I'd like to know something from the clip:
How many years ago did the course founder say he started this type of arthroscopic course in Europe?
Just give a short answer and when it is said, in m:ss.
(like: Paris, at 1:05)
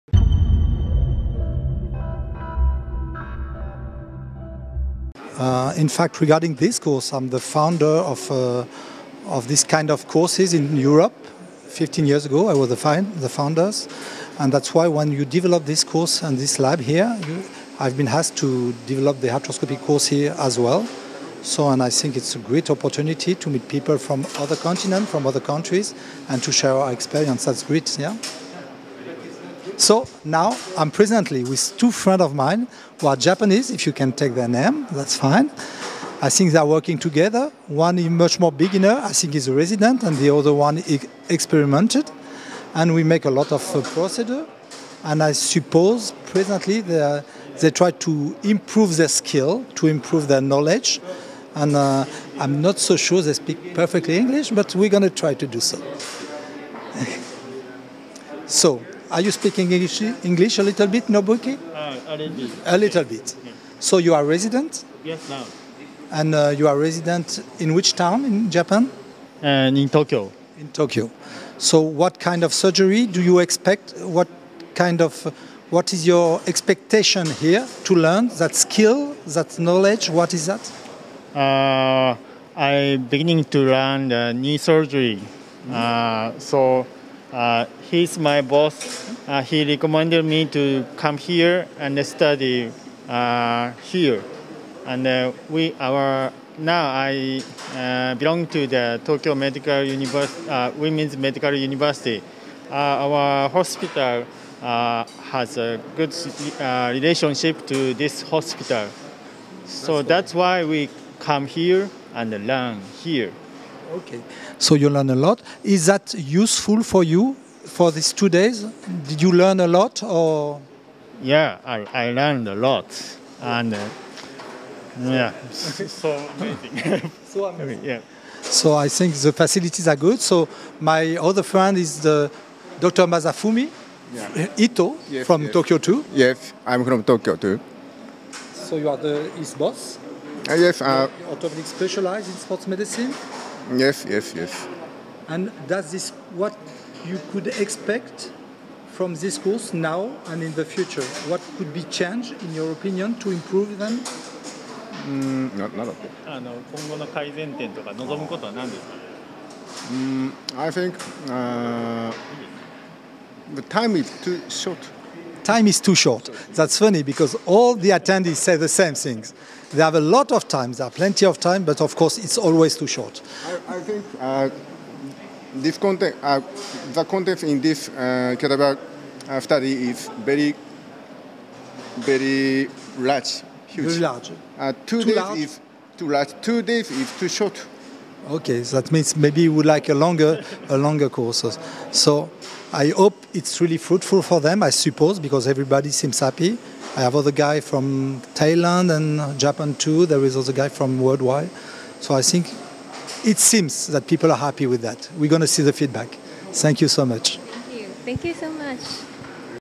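15, at 0:11.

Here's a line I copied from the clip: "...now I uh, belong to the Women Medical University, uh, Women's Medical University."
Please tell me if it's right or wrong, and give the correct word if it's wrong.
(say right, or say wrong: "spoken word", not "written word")
wrong: "Tokyo", not "Women".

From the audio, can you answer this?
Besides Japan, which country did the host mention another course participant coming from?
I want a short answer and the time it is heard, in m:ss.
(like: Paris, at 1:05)
Thailand, at 3:18.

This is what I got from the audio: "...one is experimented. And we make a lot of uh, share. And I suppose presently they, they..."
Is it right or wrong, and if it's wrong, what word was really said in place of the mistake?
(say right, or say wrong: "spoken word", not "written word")
wrong: "procedure", not "share".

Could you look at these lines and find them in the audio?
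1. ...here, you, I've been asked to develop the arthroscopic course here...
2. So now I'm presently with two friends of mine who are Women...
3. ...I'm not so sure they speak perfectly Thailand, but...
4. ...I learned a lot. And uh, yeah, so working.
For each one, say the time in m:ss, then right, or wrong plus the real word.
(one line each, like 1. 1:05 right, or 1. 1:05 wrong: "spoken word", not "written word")
1. 0:16 right
2. 0:29 wrong: "Japanese", not "Women"
3. 0:52 wrong: "English", not "Thailand"
4. 2:01 wrong: "amazing", not "working".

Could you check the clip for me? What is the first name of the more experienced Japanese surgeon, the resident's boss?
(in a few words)
Masafumi.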